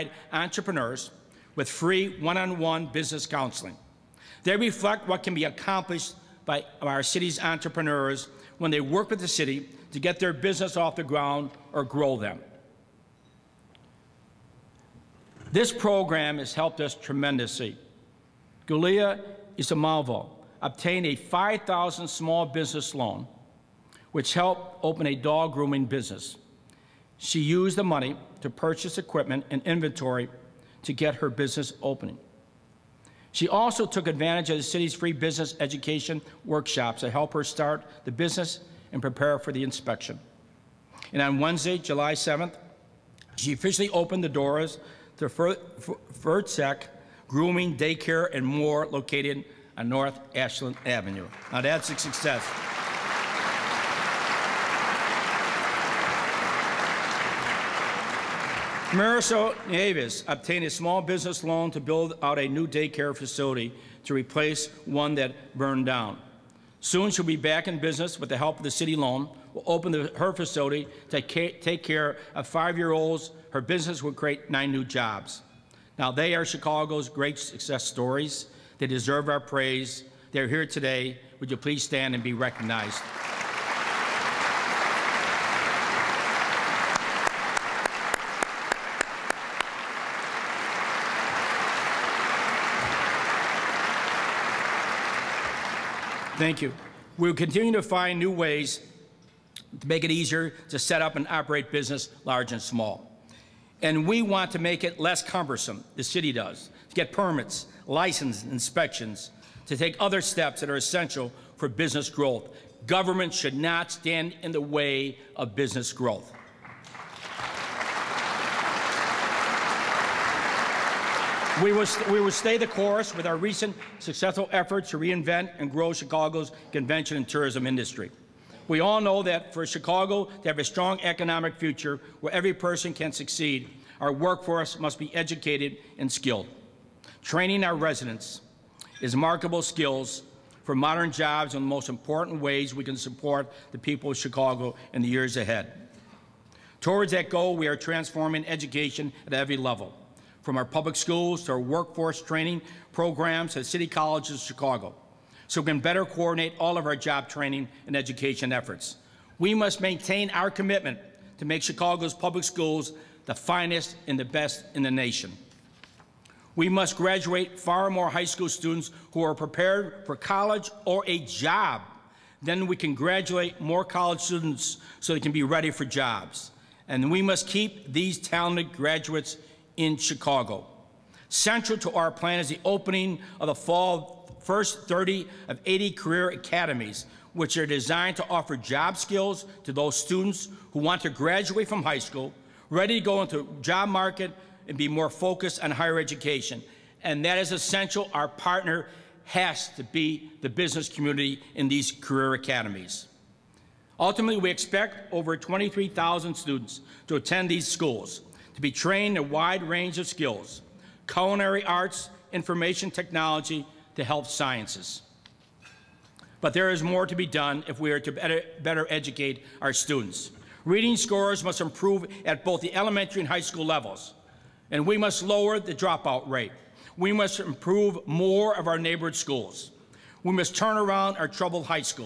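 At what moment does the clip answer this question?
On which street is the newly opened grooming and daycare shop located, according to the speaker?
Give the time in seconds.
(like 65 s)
49 s.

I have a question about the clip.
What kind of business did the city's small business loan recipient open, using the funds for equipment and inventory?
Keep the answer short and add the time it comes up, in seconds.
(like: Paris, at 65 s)
Dog grooming, at 25 s.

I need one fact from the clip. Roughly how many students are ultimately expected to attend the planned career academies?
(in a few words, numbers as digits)
23,000.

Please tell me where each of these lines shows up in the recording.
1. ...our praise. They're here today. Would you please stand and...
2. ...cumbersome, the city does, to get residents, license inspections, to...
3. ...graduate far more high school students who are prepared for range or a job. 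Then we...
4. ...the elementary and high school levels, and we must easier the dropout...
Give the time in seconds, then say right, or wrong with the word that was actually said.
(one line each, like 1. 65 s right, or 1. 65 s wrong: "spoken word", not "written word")
1. 79 s right
2. 105 s wrong: "permits", not "residents"
3. 166 s wrong: "college", not "range"
4. 222 s wrong: "lower", not "easier".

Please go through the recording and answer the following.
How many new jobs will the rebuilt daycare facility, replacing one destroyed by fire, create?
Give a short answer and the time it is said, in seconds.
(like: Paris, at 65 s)
9, at 74 s.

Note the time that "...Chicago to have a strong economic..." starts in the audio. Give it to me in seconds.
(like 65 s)
129 s.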